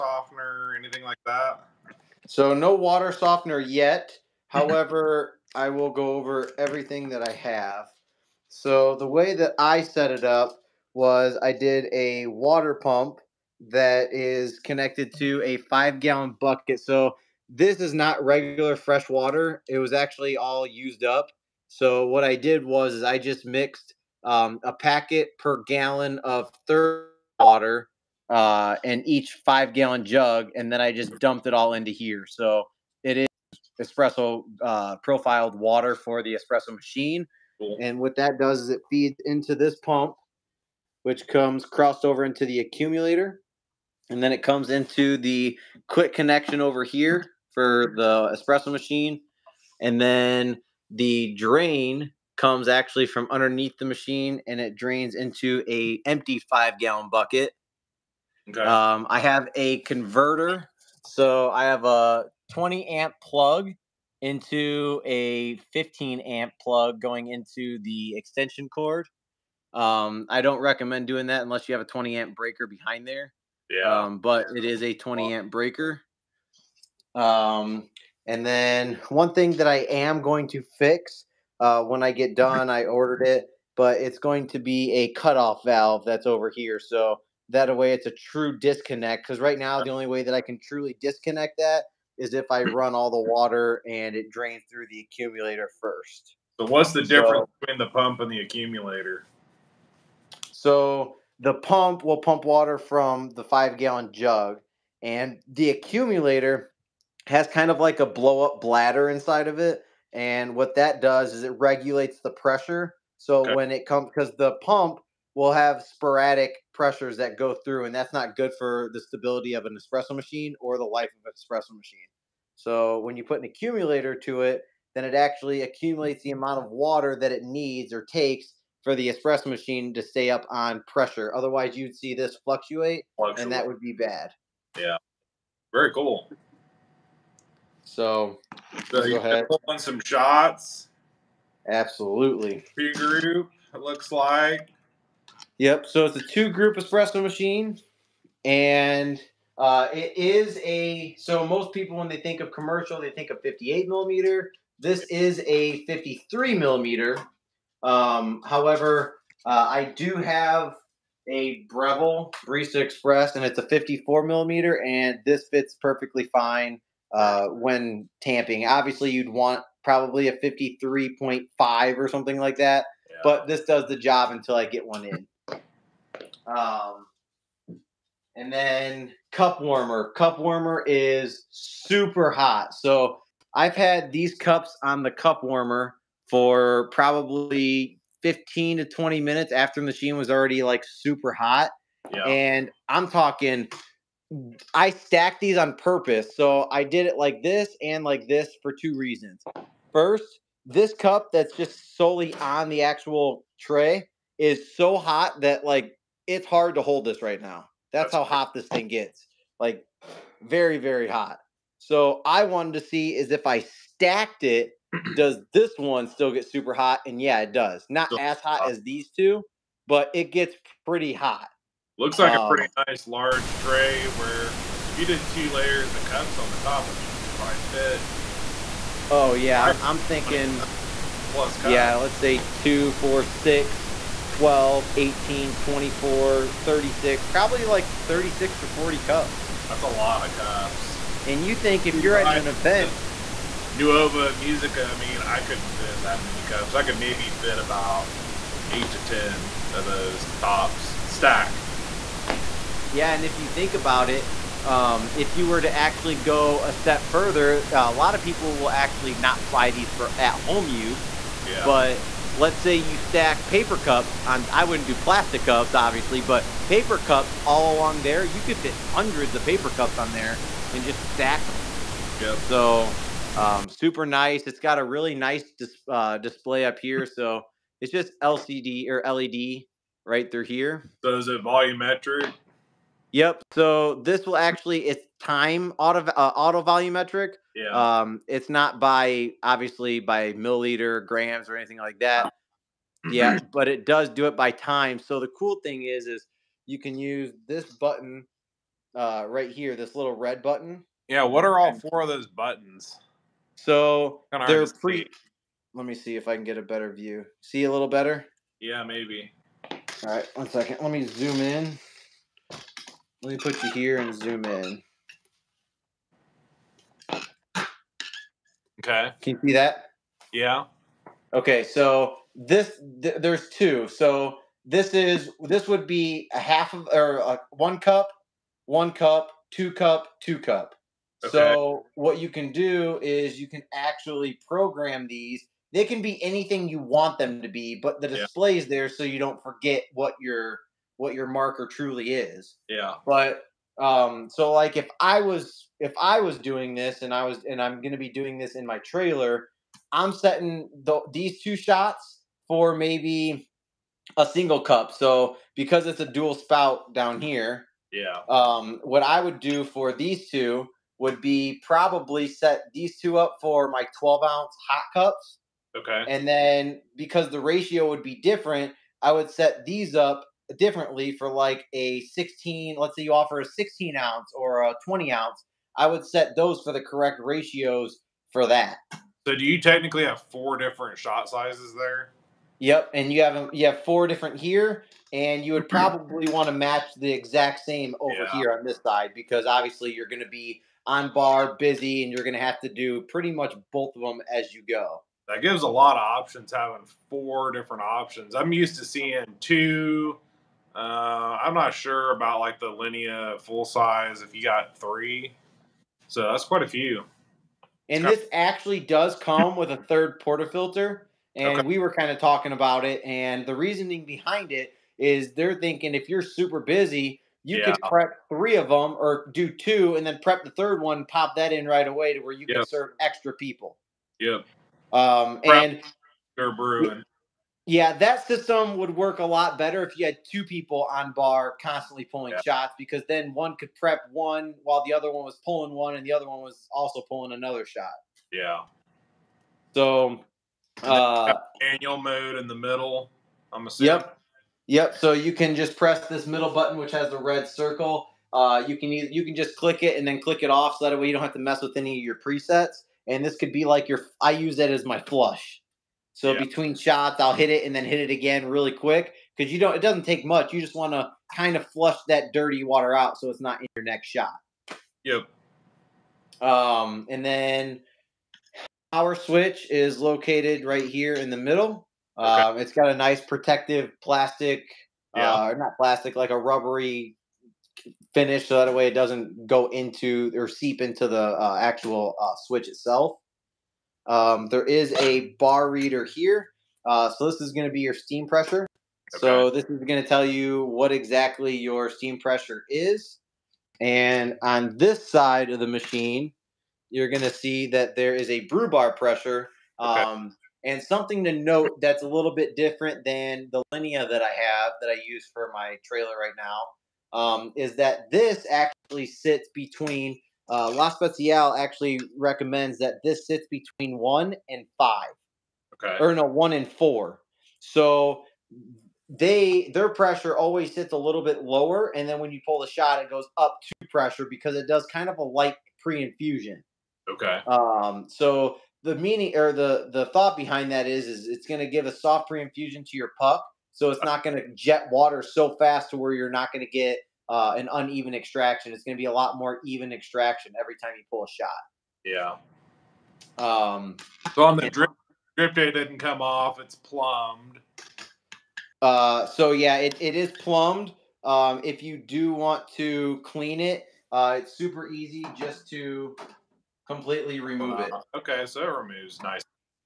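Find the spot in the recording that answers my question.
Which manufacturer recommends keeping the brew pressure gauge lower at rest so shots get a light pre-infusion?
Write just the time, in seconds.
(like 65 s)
510 s.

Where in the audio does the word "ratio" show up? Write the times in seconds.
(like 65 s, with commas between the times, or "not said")
367 s, 377 s.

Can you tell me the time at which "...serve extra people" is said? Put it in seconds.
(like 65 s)
422 s.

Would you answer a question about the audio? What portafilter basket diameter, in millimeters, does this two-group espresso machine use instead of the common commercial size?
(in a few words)
53 millimeter.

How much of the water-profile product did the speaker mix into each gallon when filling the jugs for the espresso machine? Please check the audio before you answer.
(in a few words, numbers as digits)
A packet per gallon.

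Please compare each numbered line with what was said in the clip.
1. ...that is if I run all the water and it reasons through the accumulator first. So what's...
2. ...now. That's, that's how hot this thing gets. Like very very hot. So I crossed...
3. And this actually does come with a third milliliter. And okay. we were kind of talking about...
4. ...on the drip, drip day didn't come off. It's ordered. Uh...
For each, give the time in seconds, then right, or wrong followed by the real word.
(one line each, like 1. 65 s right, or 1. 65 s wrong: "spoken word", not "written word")
1. 91 s wrong: "drains", not "reasons"
2. 207 s wrong: "wanted", not "crossed"
3. 407 s wrong: "portafilter", not "milliliter"
4. 544 s wrong: "plumbed", not "ordered".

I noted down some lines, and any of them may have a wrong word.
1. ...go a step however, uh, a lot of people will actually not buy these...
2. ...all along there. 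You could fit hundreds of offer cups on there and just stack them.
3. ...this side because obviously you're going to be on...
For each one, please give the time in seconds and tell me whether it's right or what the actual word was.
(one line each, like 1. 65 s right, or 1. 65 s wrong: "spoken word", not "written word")
1. 256 s wrong: "further", not "however"
2. 267 s wrong: "paper", not "offer"
3. 388 s right.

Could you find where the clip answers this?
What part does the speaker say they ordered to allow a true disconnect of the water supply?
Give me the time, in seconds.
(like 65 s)
85 s.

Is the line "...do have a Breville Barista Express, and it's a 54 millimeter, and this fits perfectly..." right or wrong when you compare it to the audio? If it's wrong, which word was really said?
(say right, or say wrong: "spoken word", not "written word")
right.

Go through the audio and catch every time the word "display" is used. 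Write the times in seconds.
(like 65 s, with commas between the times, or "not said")
276 s, 338 s.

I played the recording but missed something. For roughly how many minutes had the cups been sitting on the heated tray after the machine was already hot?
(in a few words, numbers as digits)
15 to 20 minutes.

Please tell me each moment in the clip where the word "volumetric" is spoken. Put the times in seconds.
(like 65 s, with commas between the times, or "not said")
281 s, 286 s.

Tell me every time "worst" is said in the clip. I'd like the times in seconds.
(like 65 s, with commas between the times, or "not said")
not said.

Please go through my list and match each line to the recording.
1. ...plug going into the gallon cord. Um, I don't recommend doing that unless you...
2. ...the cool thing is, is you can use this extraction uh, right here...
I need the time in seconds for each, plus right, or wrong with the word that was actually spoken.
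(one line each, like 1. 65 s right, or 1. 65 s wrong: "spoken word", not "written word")
1. 66 s wrong: "extension", not "gallon"
2. 295 s wrong: "button", not "extraction".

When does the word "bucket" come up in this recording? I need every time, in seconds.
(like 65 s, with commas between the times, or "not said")
16 s, 57 s.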